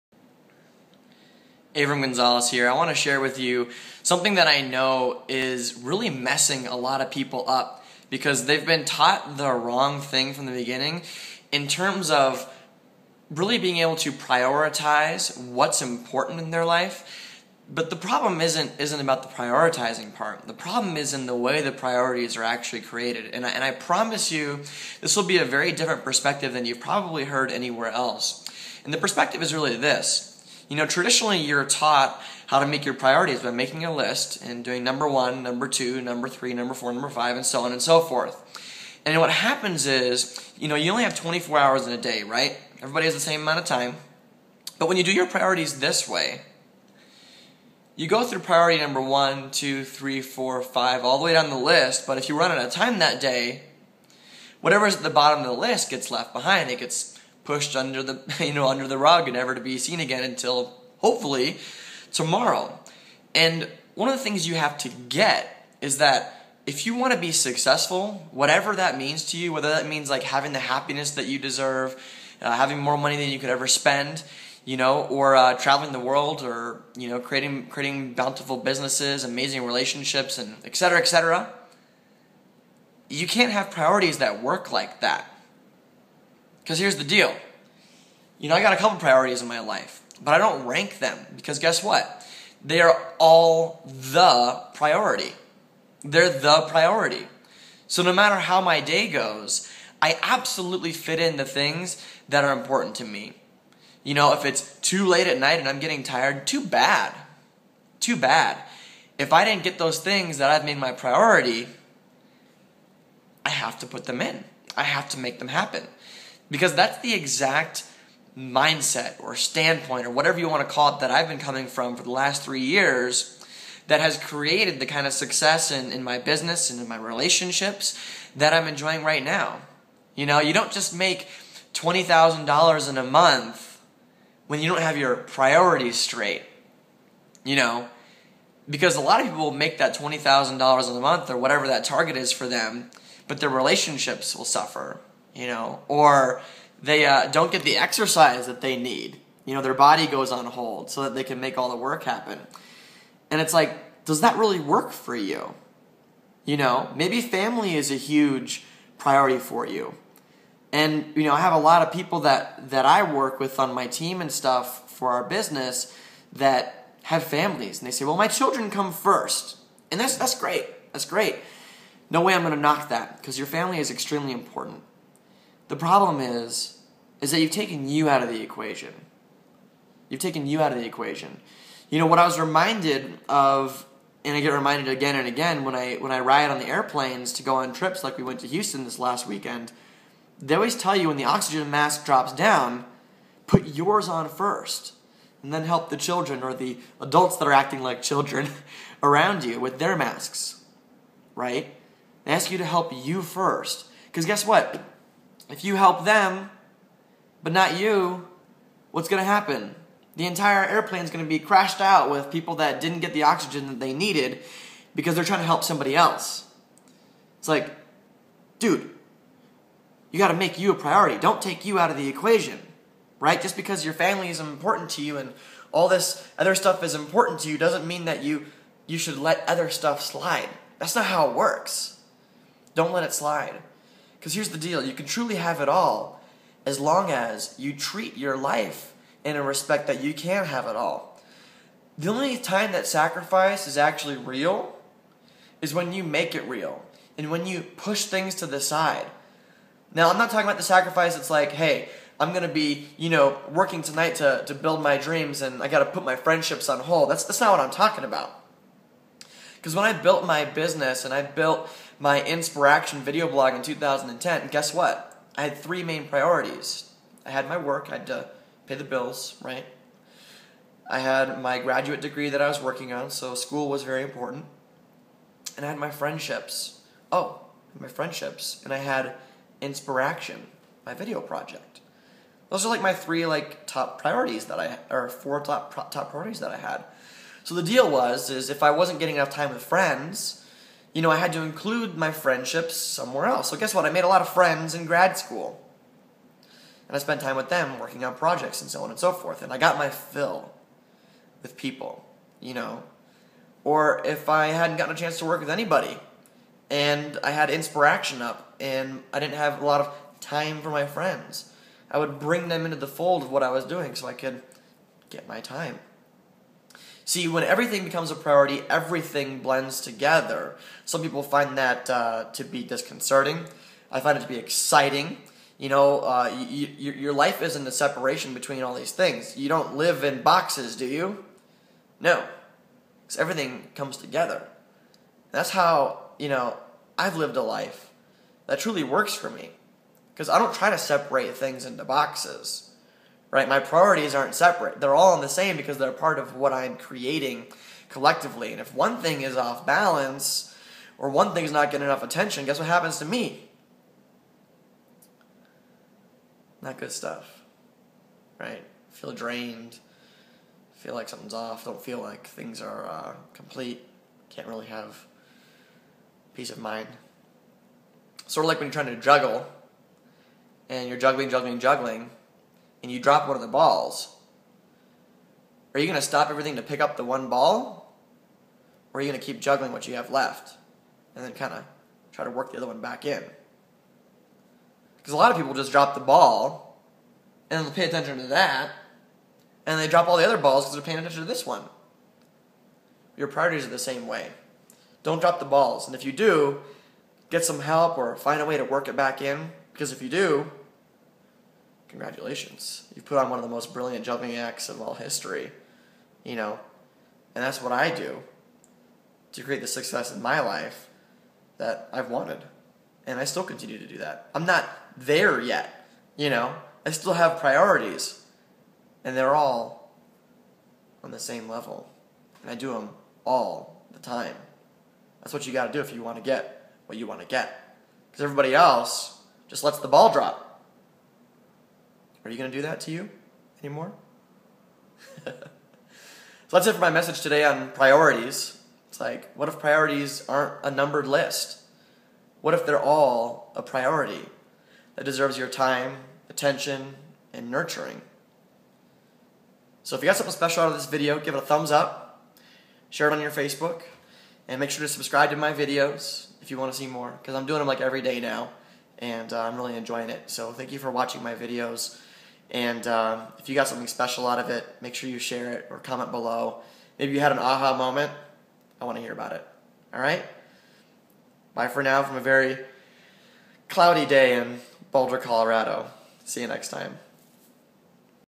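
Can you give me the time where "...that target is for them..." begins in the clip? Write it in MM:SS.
02:21.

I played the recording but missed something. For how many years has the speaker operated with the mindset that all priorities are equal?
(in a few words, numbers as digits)
3.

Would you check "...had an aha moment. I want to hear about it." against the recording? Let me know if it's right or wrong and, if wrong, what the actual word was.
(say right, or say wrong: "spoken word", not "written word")
right.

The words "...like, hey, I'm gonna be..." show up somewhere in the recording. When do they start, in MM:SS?
04:11.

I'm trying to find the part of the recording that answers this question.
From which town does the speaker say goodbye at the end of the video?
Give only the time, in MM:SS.
07:54.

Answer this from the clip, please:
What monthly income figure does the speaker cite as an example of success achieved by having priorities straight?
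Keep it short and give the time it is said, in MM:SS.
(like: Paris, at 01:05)
$20,000, at 02:11.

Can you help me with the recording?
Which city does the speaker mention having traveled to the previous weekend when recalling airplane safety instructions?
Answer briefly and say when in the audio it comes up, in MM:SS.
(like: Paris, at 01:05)
Houston, at 03:08.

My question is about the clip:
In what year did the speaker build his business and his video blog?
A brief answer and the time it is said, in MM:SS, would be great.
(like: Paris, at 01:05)
2010, at 04:23.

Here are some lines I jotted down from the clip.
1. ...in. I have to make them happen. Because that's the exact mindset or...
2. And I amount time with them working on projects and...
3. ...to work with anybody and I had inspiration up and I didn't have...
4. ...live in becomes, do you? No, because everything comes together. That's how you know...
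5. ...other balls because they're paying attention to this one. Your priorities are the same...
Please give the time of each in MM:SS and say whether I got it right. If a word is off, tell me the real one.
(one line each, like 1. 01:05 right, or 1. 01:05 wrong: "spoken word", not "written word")
1. 01:54 right
2. 04:56 wrong: "spent", not "amount"
3. 05:05 right
4. 05:29 wrong: "boxes", not "becomes"
5. 06:30 right.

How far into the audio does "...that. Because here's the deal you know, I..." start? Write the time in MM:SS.
01:25.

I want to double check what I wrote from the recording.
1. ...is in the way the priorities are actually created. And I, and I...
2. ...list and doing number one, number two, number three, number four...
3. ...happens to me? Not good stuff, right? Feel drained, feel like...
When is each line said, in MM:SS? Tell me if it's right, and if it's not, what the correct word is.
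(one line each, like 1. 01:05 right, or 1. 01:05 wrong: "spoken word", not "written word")
1. 00:20 right
2. 00:33 right
3. 05:52 right.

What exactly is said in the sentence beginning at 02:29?
You know, their body goes on hold so that they can make all the work happen.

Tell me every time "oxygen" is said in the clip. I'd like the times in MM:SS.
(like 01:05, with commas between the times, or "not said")
03:11, 03:33.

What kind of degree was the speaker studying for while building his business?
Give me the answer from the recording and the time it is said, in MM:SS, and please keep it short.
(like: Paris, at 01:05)
graduate degree, at 04:31.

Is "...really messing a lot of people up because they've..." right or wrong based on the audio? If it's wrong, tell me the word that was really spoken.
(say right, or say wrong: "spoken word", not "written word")
right.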